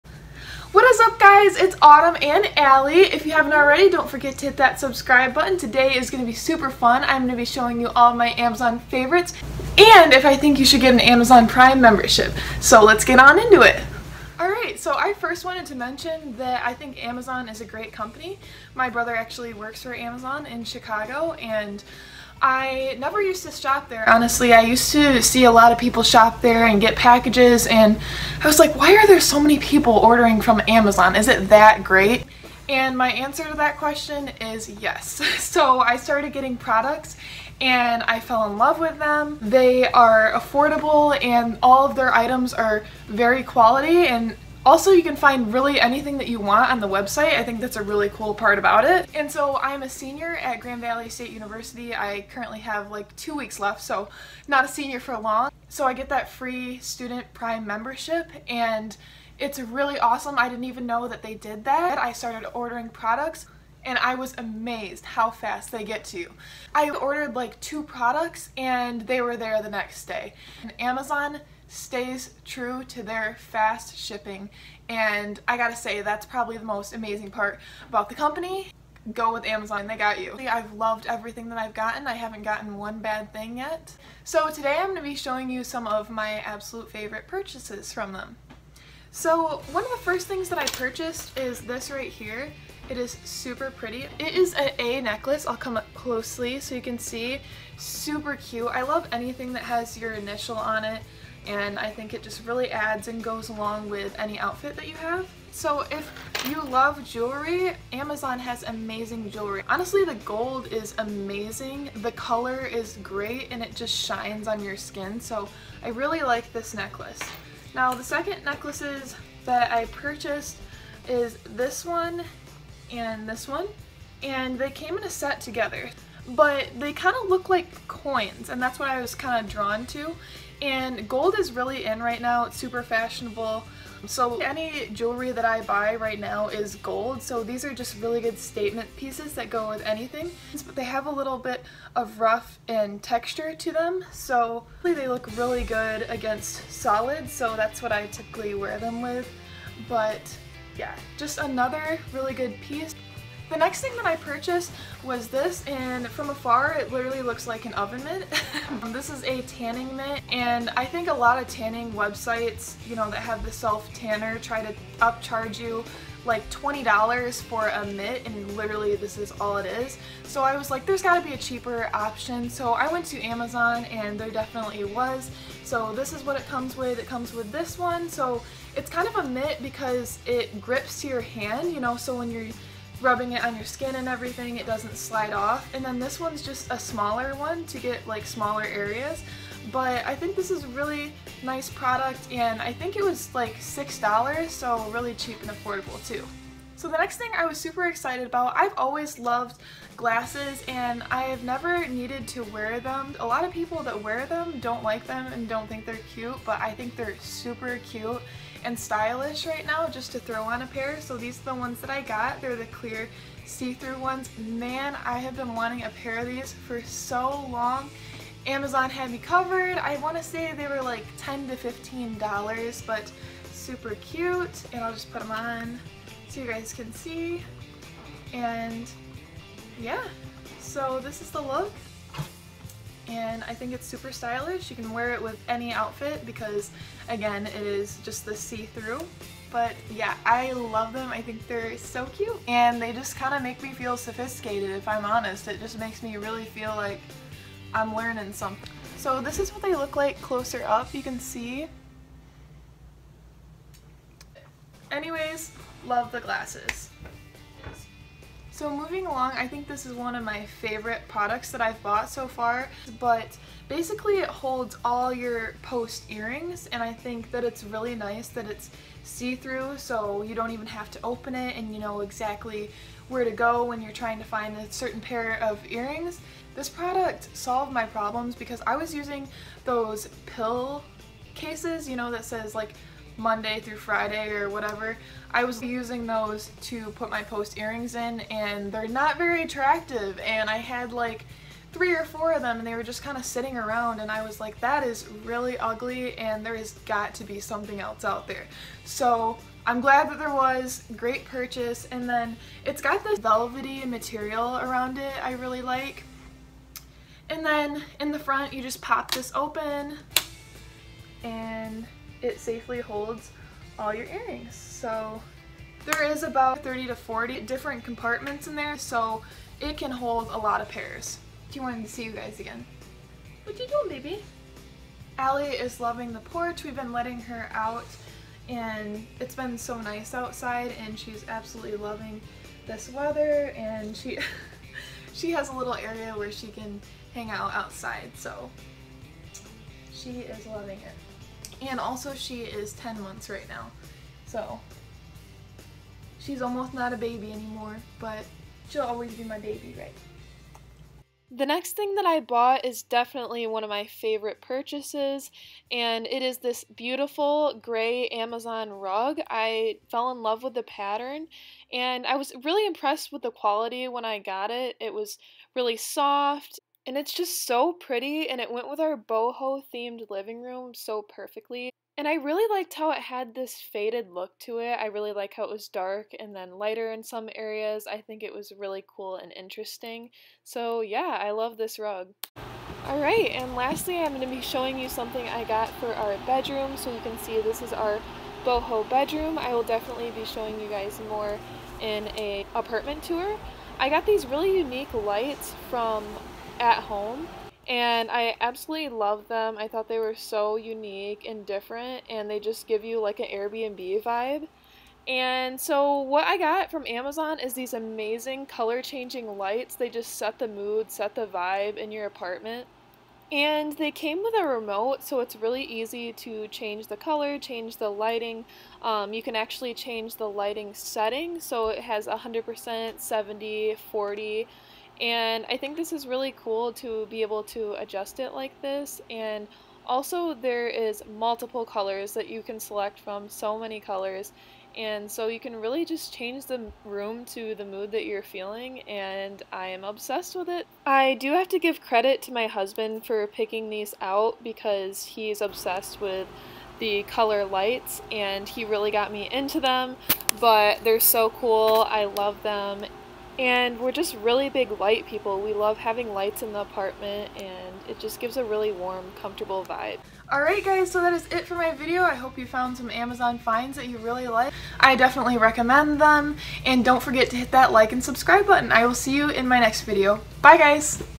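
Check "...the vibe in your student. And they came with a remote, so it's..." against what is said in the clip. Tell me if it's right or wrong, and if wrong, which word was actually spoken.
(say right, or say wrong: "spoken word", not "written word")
wrong: "apartment", not "student".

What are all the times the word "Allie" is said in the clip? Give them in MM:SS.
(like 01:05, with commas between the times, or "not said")
00:02, 05:25.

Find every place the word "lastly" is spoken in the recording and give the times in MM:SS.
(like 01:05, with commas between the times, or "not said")
06:23.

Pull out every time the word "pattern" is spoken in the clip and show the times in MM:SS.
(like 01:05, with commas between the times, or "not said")
06:00.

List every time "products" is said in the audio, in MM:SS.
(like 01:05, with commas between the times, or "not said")
00:36, 01:02, 01:07, 03:11, 04:21, 04:36.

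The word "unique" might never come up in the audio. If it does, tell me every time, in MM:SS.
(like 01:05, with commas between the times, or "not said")
06:34, 06:40.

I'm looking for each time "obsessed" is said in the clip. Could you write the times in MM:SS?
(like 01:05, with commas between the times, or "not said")
07:19, 07:25.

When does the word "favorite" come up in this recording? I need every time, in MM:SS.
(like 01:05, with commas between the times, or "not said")
00:08, 01:26, 04:20, 05:53.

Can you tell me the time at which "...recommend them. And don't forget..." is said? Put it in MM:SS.
07:45.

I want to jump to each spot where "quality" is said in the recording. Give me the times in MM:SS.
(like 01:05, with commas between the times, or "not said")
00:43, 06:03.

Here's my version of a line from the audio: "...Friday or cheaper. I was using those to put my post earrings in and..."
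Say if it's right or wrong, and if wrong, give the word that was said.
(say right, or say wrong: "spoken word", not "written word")
wrong: "whatever", not "cheaper".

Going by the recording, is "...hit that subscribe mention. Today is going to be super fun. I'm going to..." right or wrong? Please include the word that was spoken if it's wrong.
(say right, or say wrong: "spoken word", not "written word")
wrong: "button", not "mention".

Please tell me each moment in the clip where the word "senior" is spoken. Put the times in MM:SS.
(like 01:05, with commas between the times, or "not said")
00:49, 00:54.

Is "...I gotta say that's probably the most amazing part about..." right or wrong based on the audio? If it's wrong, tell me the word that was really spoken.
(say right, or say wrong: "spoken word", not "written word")
right.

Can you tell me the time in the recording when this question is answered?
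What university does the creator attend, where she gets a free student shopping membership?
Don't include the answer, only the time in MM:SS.
00:50.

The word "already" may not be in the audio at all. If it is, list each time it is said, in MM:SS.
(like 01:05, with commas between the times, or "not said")
00:03.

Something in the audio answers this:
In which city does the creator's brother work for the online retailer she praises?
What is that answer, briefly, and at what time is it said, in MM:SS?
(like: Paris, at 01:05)
Chicago, at 00:20.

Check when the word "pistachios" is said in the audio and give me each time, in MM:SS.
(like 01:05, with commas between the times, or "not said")
not said.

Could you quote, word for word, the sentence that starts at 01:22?
I haven't gotten one bad thing yet.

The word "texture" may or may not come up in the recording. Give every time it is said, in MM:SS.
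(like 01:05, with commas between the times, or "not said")
02:23.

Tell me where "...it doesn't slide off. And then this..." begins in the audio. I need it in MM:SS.
03:04.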